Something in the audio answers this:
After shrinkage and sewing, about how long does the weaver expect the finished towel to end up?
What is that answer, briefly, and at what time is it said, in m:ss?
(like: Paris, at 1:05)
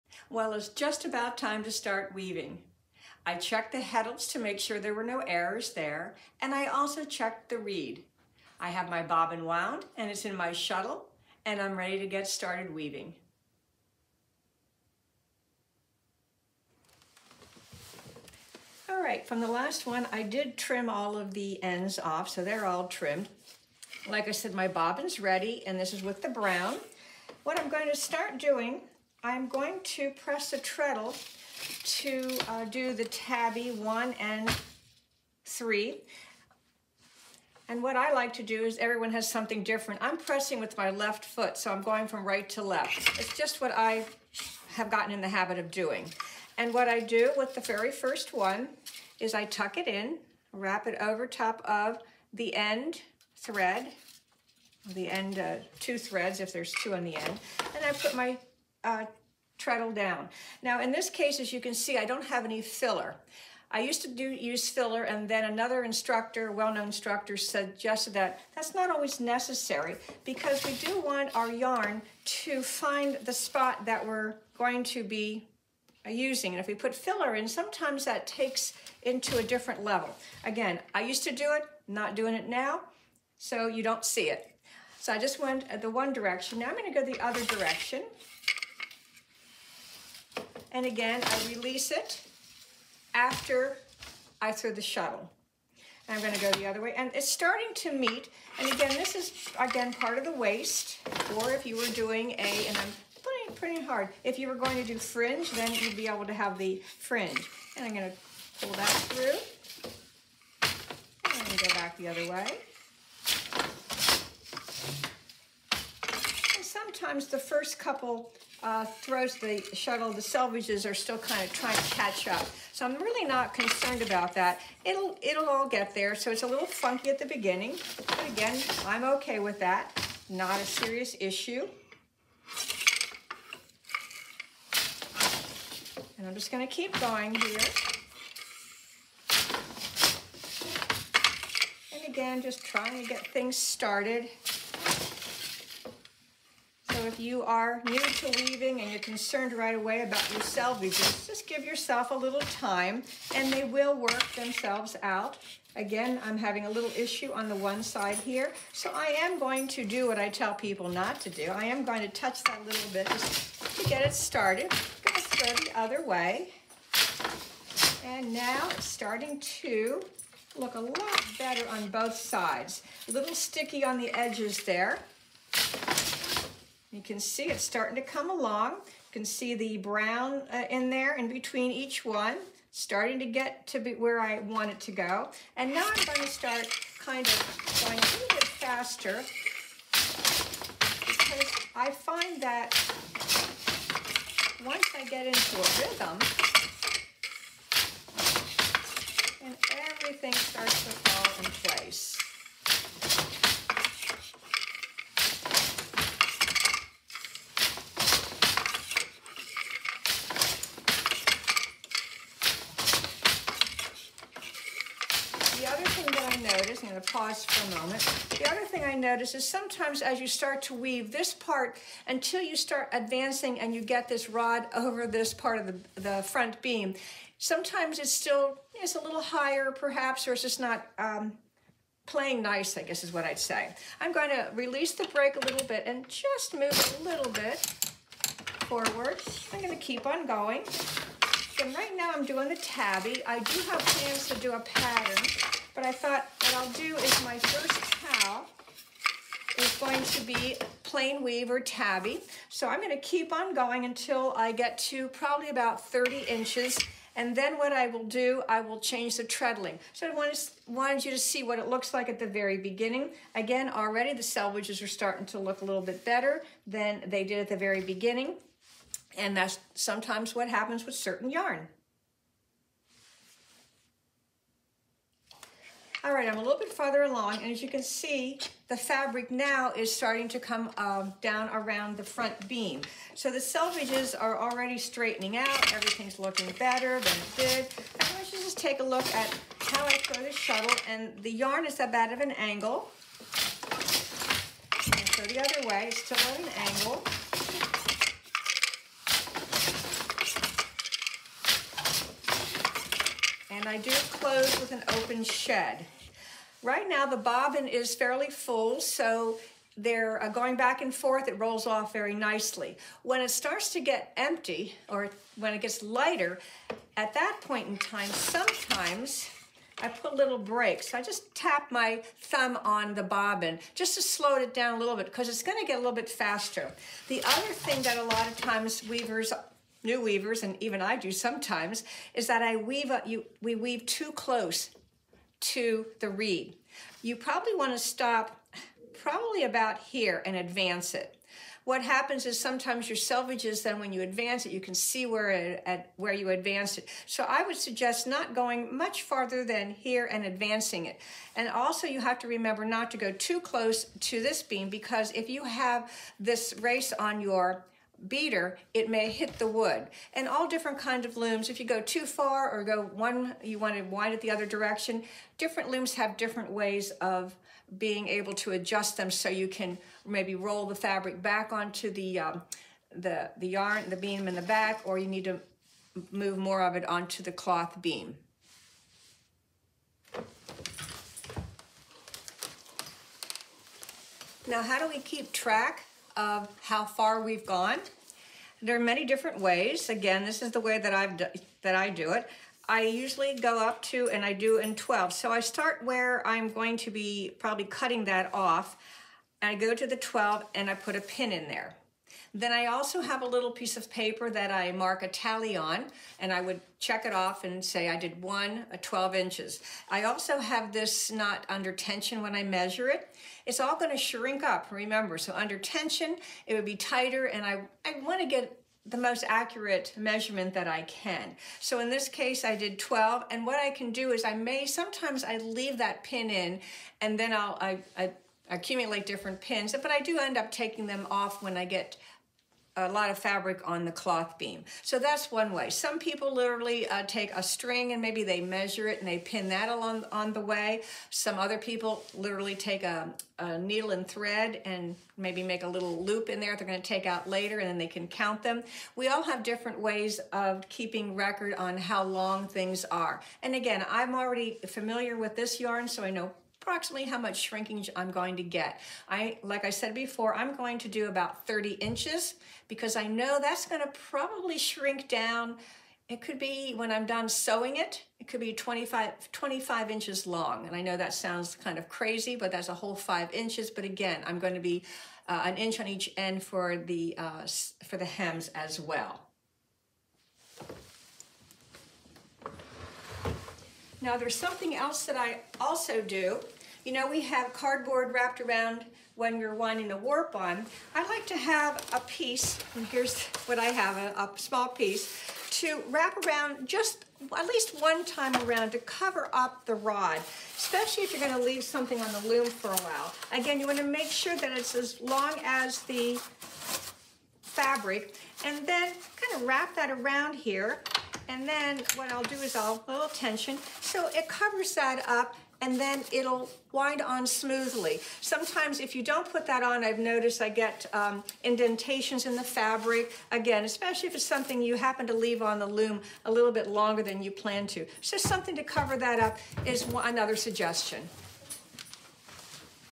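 25 inches, at 7:48.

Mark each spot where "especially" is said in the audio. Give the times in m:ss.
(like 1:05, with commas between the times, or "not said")
8:20, 8:43.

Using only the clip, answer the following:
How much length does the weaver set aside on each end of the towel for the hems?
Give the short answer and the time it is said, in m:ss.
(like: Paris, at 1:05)
an inch, at 7:55.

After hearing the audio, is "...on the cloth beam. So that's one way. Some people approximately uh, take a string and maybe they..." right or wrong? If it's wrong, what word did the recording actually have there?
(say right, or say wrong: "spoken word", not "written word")
wrong: "literally", not "approximately".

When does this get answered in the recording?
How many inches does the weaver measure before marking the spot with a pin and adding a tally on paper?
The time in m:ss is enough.
6:39.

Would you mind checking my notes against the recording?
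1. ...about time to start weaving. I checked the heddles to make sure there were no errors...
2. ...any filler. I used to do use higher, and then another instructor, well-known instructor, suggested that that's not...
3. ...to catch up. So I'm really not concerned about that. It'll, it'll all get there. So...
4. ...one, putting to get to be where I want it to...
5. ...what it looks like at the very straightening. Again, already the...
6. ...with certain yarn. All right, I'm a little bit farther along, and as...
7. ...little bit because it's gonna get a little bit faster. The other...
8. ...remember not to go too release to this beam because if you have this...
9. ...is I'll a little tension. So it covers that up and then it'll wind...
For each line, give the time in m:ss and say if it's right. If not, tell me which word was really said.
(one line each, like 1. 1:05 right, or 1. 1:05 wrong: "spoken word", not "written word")
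1. 0:01 right
2. 1:02 wrong: "filler", not "higher"
3. 2:01 right
4. 3:02 wrong: "starting", not "putting"
5. 4:21 wrong: "beginning", not "straightening"
6. 4:30 right
7. 5:24 right
8. 5:52 wrong: "close", not "release"
9. 8:32 right.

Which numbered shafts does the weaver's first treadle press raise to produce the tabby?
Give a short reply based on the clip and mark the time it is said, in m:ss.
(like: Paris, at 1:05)
one and three, at 0:33.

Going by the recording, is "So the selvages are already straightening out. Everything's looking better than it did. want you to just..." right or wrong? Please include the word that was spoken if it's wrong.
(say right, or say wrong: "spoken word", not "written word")
right.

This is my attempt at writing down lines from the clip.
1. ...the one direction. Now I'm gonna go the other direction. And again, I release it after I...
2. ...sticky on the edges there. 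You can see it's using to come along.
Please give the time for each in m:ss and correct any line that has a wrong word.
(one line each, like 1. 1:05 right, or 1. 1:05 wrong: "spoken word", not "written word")
1. 1:25 right
2. 2:53 wrong: "starting", not "using".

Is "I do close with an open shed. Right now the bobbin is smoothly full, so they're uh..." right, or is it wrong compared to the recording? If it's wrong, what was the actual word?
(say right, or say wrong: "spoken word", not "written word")
wrong: "fairly", not "smoothly".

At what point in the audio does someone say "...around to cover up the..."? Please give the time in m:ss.
8:18.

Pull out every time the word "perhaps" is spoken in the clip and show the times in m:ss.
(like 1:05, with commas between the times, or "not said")
3:49.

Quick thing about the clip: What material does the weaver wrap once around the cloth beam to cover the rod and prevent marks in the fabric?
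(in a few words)
cardboard.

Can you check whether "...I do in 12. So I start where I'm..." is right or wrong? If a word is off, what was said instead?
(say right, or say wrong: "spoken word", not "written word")
right.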